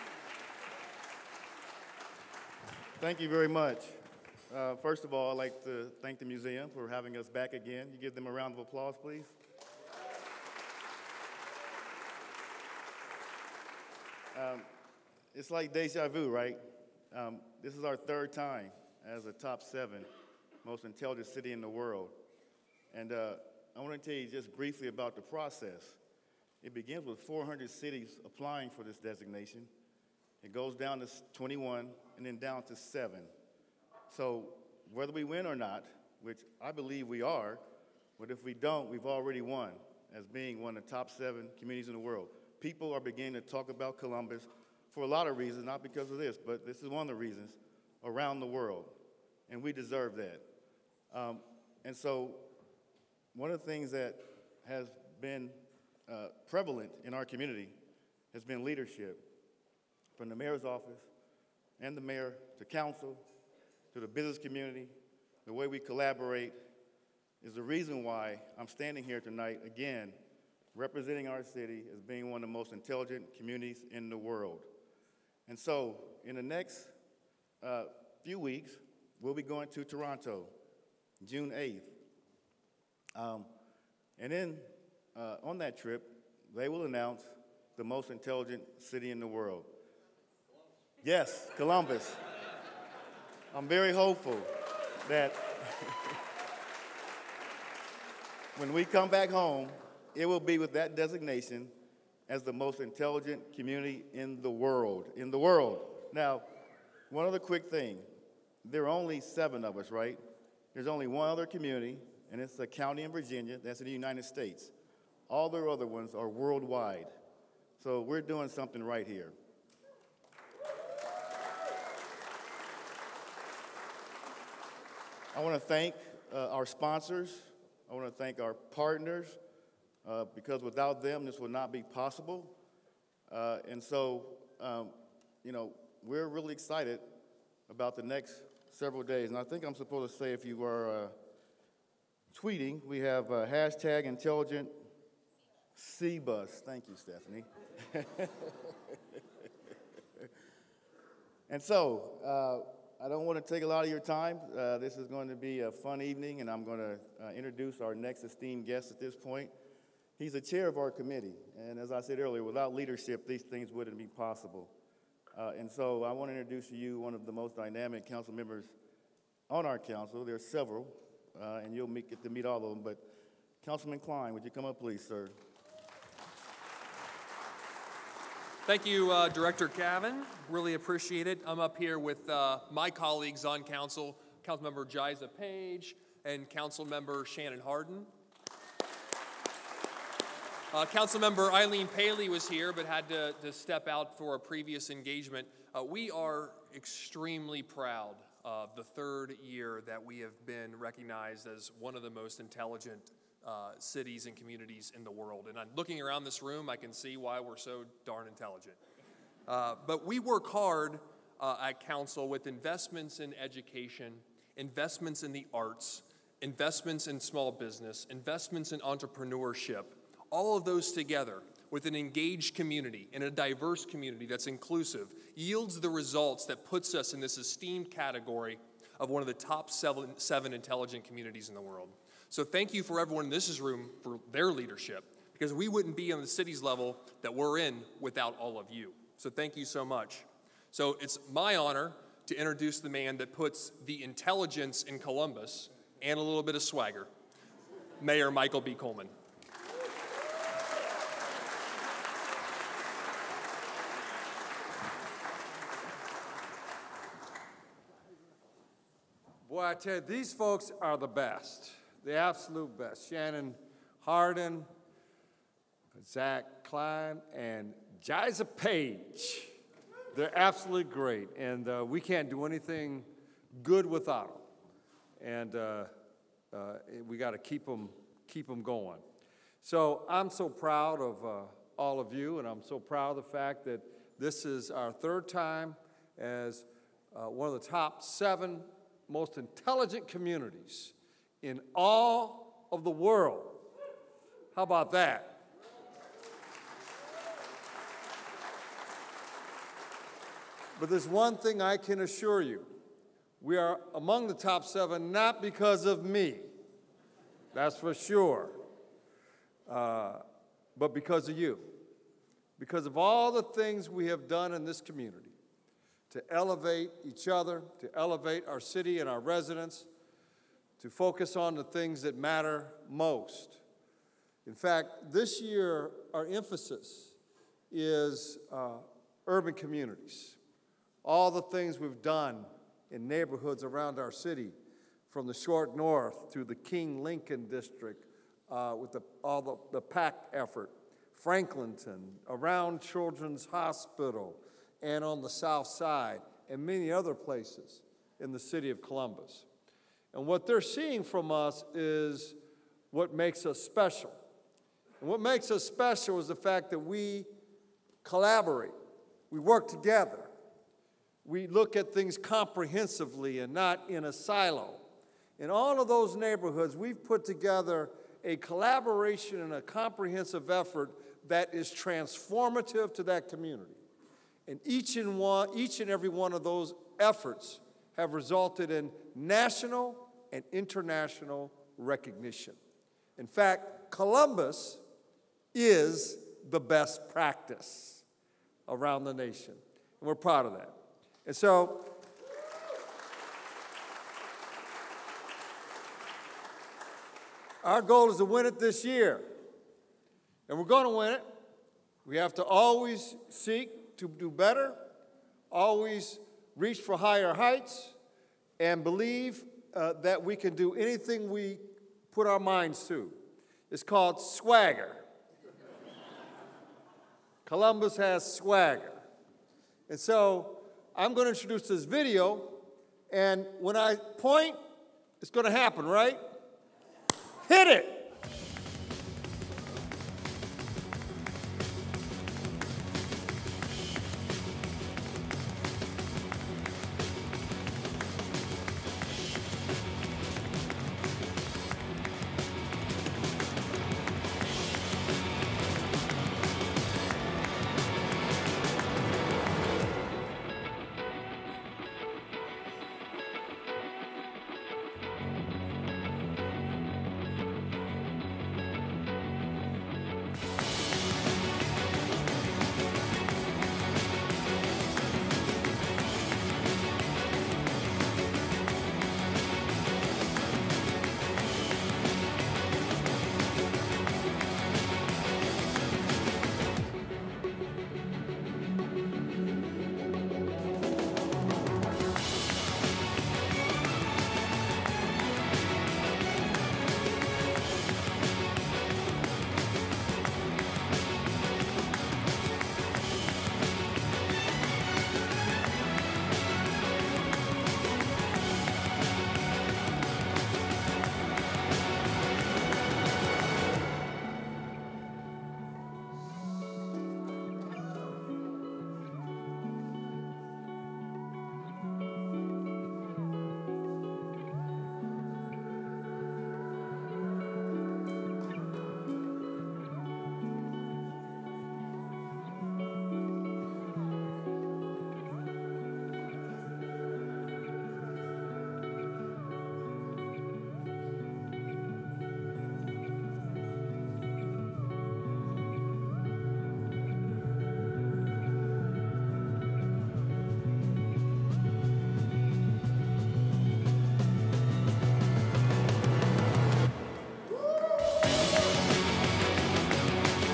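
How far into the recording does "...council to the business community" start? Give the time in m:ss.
1:02.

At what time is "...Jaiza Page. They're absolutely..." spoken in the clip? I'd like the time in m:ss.
4:28.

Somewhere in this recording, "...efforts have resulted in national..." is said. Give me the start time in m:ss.
6:16.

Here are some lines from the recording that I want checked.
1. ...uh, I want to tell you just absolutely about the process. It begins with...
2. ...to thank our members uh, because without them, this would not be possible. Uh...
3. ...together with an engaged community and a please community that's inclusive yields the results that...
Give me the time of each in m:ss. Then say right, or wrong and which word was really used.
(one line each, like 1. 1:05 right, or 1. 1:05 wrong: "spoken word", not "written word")
1. 0:23 wrong: "briefly", not "absolutely"
2. 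2:08 wrong: "partners", not "members"
3. 3:40 wrong: "diverse", not "please".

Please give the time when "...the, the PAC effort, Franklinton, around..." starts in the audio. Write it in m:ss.
5:39.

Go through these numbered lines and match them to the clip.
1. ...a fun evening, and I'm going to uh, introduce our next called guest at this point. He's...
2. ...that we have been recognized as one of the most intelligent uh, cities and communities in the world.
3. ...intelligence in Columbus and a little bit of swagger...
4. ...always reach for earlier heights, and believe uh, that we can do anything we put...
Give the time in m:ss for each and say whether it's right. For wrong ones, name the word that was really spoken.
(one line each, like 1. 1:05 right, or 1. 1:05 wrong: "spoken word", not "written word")
1. 2:35 wrong: "esteemed", not "called"
2. 3:19 right
3. 4:04 right
4. 6:45 wrong: "higher", not "earlier".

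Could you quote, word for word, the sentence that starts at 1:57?
So we're doing something right here.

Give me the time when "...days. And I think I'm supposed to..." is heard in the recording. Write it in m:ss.
2:19.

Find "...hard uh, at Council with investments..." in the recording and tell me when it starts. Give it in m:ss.
3:30.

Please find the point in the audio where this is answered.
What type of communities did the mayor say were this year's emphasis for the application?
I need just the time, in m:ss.
5:29.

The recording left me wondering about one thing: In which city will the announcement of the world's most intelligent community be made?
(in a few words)
Toronto.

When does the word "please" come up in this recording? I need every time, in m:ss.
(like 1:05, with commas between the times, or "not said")
0:09, 2:54.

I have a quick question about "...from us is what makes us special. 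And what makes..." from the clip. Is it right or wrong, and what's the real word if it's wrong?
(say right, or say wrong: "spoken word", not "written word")
right.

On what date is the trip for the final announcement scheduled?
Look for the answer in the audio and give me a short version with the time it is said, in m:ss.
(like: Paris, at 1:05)
June 8, at 1:21.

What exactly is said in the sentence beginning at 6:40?
And we're going to win it.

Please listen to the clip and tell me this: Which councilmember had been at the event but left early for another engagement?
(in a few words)
Eileen Paley.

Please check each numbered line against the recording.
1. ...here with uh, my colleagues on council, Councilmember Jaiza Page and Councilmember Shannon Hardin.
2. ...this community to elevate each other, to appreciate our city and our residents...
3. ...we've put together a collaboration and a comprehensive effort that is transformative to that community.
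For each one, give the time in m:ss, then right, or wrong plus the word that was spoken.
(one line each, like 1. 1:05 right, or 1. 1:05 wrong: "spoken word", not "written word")
1. 3:01 right
2. 5:14 wrong: "elevate", not "appreciate"
3. 6:06 right.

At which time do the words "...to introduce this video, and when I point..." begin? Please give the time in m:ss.
7:01.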